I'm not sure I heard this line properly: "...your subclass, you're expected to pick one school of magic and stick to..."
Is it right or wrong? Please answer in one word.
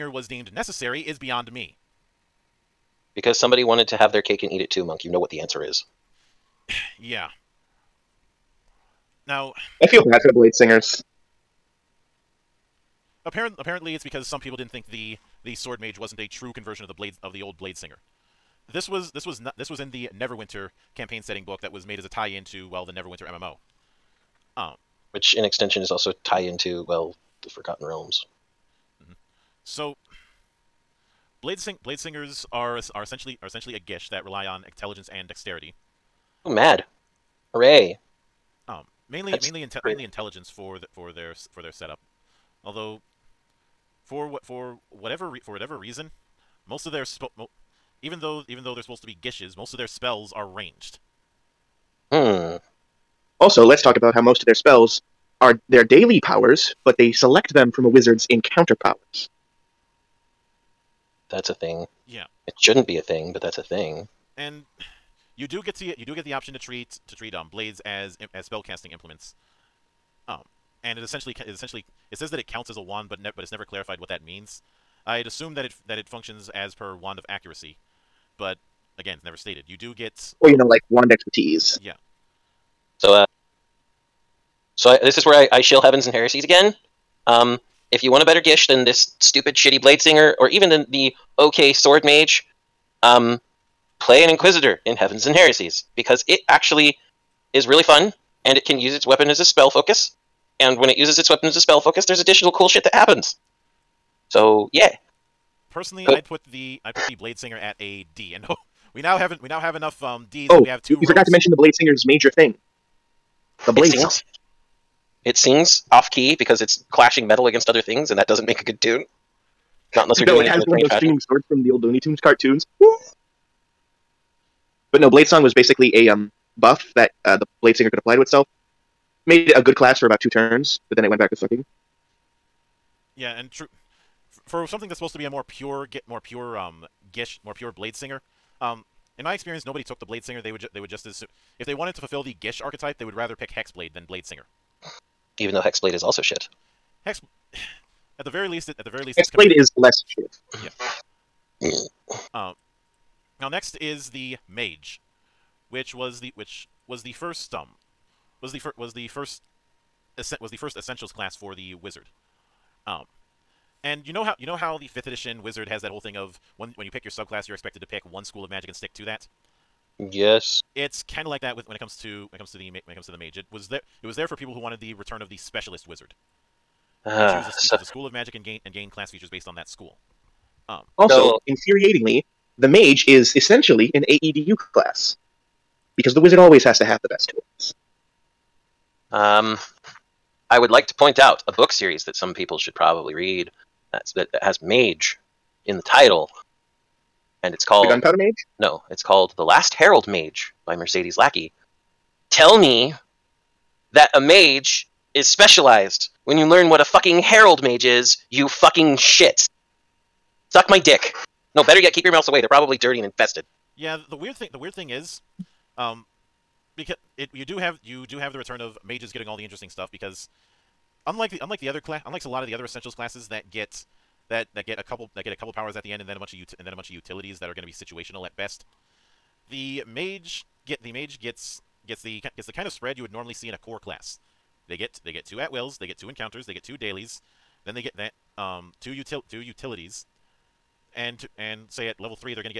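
right.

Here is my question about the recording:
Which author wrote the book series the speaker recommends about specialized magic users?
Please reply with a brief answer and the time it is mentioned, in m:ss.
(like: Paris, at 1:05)
Mercedes Lackey, at 3:20.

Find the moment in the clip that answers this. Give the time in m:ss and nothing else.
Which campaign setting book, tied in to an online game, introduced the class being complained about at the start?
0:20.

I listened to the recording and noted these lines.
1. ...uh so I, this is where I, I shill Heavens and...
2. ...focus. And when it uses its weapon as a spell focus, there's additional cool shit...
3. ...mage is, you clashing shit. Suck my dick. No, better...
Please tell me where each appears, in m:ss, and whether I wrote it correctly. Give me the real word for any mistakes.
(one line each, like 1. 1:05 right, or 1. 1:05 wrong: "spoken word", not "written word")
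1. 1:23 right
2. 1:39 right
3. 3:27 wrong: "fucking", not "clashing".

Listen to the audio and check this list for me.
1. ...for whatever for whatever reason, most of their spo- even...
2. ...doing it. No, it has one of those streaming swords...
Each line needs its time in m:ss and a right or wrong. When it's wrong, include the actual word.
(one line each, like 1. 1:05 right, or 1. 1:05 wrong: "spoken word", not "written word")
1. 0:44 right
2. 2:00 right.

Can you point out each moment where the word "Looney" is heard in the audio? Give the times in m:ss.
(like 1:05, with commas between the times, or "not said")
2:01.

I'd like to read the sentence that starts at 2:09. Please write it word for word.
Made it a good class for about two turns, but then it went back to sucking.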